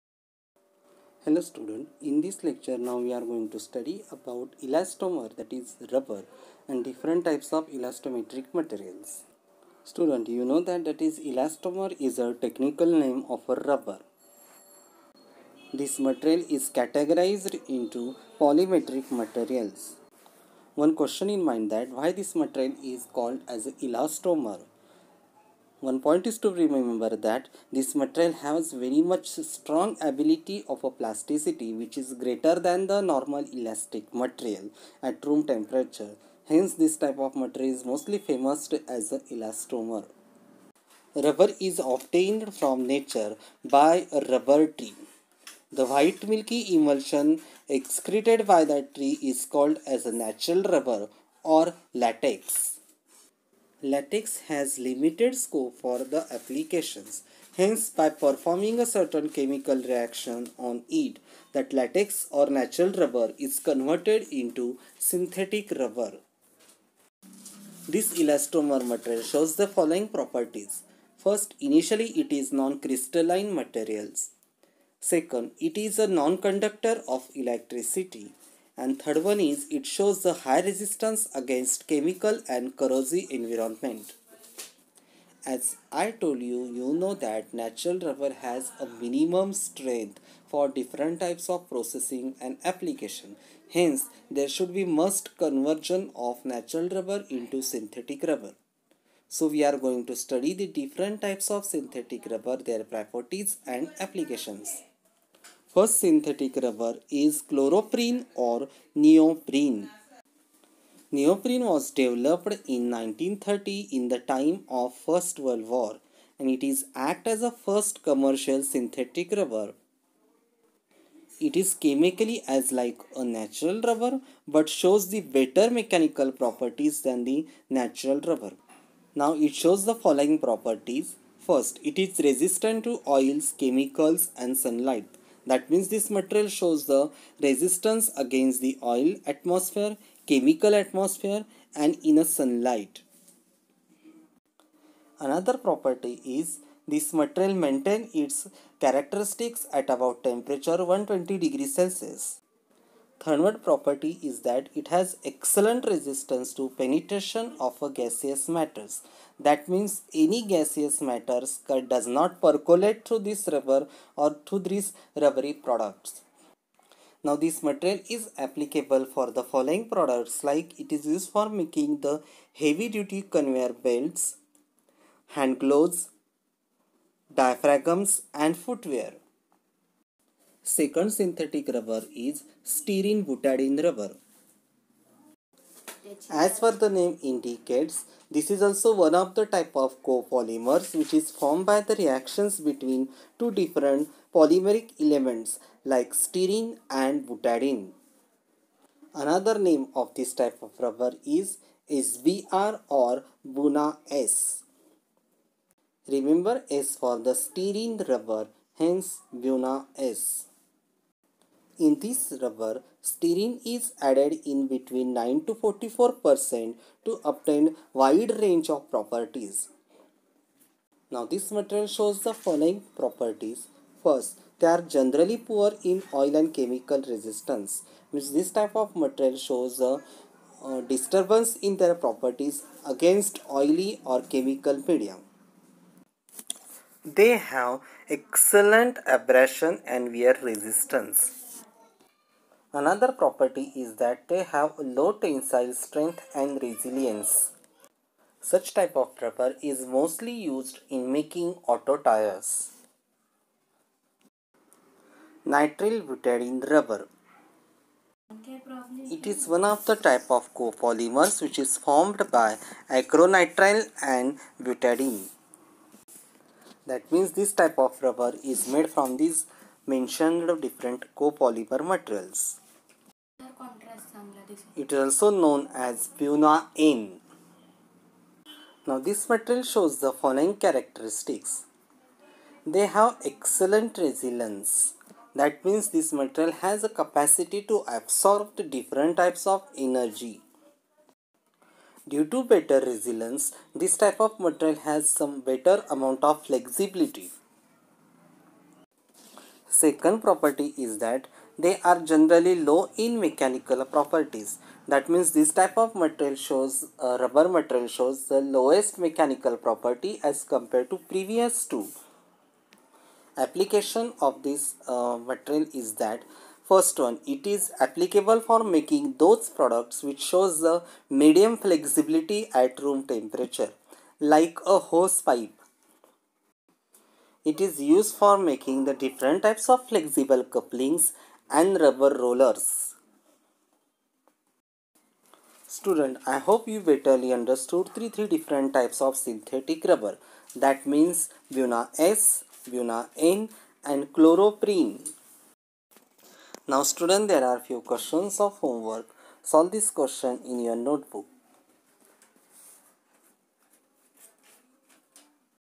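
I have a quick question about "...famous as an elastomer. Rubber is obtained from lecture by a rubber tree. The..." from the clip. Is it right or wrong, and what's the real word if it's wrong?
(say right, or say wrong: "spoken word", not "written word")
wrong: "nature", not "lecture".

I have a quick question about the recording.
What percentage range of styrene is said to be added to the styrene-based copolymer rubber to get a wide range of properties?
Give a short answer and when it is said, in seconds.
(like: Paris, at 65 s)
9 to 44%, at 215 s.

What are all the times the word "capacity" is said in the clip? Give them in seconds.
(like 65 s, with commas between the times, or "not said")
286 s.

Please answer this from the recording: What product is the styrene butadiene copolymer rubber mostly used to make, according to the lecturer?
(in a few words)
Auto tires.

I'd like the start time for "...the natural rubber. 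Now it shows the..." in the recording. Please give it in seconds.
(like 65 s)
127 s.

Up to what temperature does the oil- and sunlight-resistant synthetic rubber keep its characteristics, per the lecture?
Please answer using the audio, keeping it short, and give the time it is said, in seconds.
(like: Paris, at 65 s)
120 degrees Celsius, at 150 s.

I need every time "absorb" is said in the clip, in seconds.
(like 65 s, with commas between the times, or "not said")
287 s.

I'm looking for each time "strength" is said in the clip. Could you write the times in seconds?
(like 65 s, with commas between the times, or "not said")
89 s, 245 s.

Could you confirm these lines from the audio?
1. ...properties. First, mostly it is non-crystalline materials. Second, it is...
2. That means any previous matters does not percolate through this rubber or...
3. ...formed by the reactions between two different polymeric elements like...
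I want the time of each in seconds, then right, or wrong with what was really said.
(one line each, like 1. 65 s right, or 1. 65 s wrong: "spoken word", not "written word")
1. 70 s wrong: "initially", not "mostly"
2. 159 s wrong: "gaseous", not "previous"
3. 191 s right.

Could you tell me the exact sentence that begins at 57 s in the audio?
Hence, by performing a certain chemical reaction on it, that latex or natural rubber is converted into synthetic rubber.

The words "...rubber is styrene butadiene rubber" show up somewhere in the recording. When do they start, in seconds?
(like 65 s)
181 s.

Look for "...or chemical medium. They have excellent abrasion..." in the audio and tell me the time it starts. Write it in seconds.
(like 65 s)
234 s.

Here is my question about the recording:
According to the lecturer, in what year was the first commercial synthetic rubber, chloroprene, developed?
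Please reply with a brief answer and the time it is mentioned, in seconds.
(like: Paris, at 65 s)
1930, at 112 s.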